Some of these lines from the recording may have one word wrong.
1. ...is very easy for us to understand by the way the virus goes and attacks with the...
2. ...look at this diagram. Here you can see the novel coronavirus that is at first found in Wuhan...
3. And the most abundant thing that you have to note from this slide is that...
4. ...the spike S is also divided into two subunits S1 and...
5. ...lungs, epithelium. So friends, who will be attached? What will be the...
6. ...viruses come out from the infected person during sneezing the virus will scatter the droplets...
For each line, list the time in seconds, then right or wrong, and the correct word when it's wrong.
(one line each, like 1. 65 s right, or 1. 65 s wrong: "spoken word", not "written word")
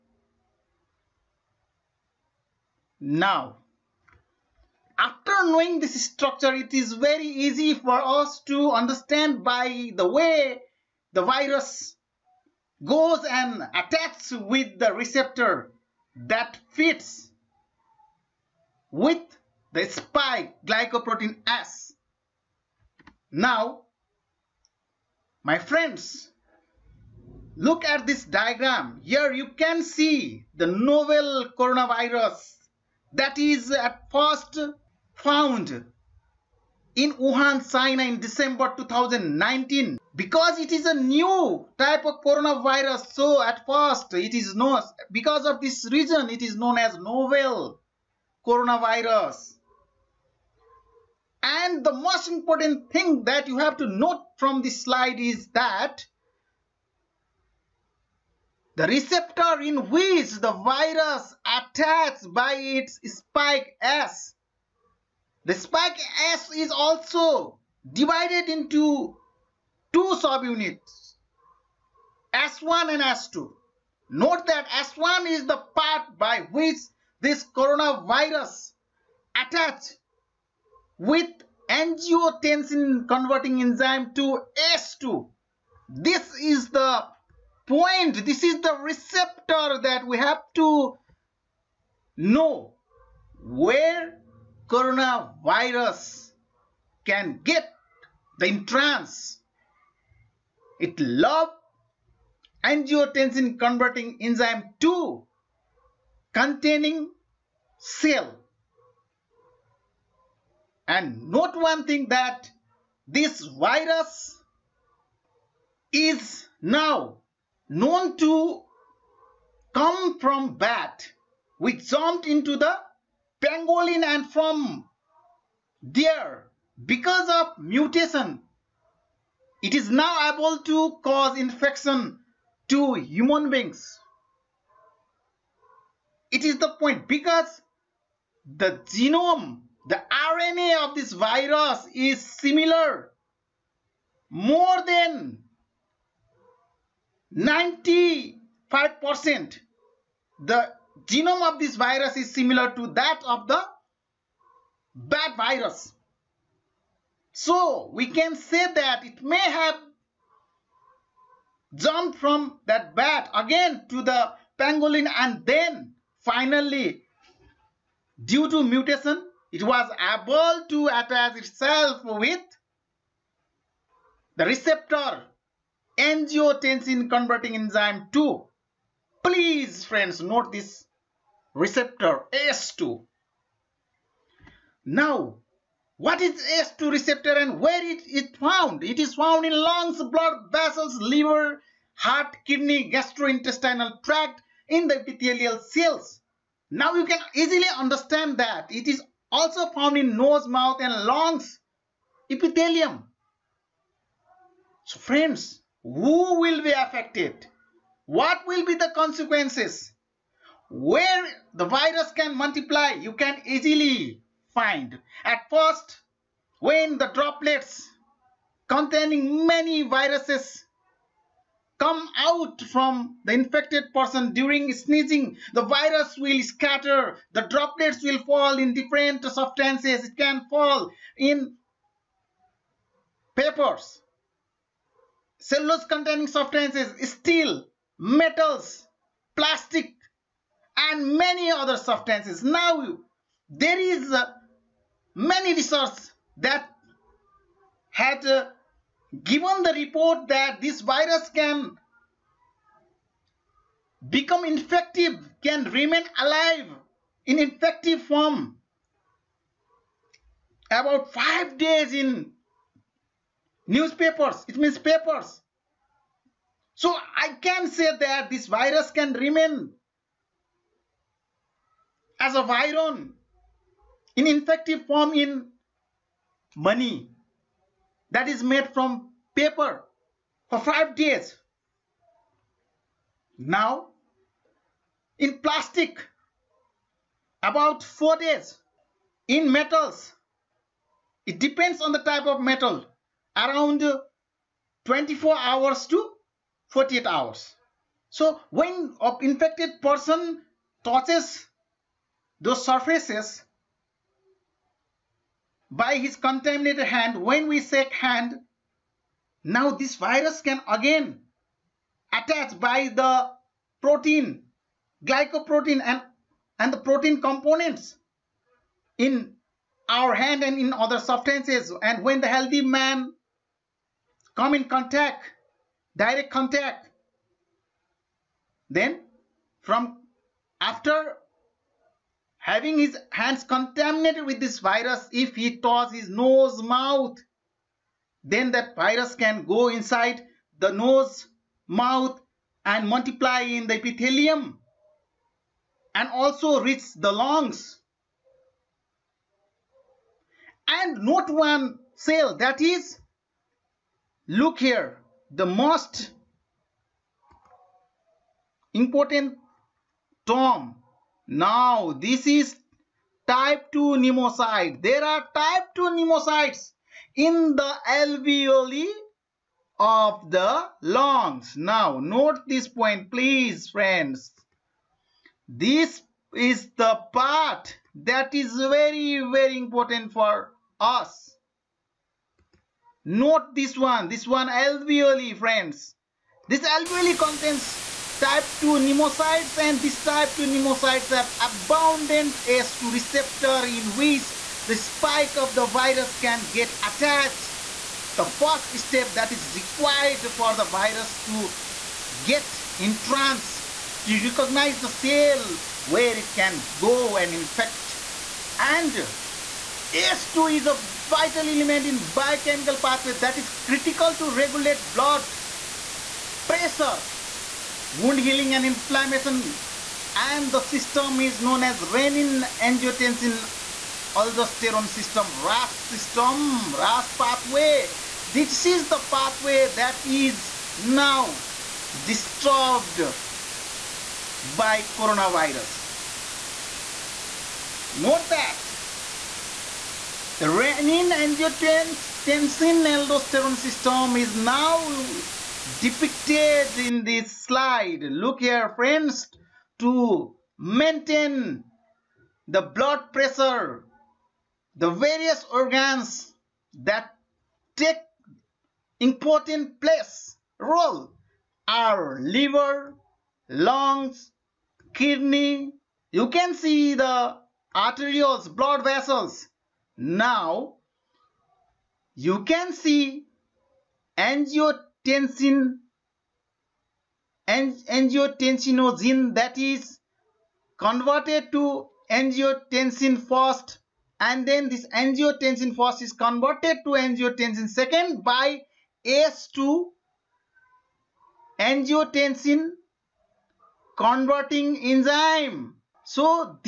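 1. 6 s right
2. 27 s right
3. 51 s wrong: "important", not "abundant"
4. 65 s right
5. 201 s wrong: "affected", not "attached"
6. 219 s right.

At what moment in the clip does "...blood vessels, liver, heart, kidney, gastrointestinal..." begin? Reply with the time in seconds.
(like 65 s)
190 s.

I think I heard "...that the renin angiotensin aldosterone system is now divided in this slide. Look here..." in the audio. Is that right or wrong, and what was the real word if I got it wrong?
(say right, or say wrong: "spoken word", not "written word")
wrong: "depicted", not "divided".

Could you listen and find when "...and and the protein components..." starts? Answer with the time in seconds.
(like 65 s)
315 s.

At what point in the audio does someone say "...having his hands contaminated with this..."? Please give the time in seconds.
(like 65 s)
332 s.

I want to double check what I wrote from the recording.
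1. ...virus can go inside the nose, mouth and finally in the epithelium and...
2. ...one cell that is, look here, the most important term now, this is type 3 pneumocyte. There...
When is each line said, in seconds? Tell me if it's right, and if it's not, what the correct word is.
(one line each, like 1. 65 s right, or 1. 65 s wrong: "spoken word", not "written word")
1. 338 s wrong: "multiply", not "finally"
2. 351 s wrong: "2", not "3".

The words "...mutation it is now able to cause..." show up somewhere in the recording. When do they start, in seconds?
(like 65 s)
127 s.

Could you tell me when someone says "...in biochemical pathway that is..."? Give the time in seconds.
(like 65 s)
411 s.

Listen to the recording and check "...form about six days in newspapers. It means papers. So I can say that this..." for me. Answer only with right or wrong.
wrong.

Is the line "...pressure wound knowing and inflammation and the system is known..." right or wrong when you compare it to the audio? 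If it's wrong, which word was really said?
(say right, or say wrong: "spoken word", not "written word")
wrong: "healing", not "knowing".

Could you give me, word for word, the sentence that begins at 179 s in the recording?
Please friends note this receptor ACE2.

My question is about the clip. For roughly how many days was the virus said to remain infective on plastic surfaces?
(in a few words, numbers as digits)
4 days.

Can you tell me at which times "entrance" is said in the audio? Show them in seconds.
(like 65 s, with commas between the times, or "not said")
98 s, 402 s.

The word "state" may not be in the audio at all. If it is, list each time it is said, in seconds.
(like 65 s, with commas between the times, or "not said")
not said.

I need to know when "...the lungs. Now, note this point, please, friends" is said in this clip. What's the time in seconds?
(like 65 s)
370 s.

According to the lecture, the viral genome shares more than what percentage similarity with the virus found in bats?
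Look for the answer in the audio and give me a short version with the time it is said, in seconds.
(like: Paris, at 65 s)
95%, at 147 s.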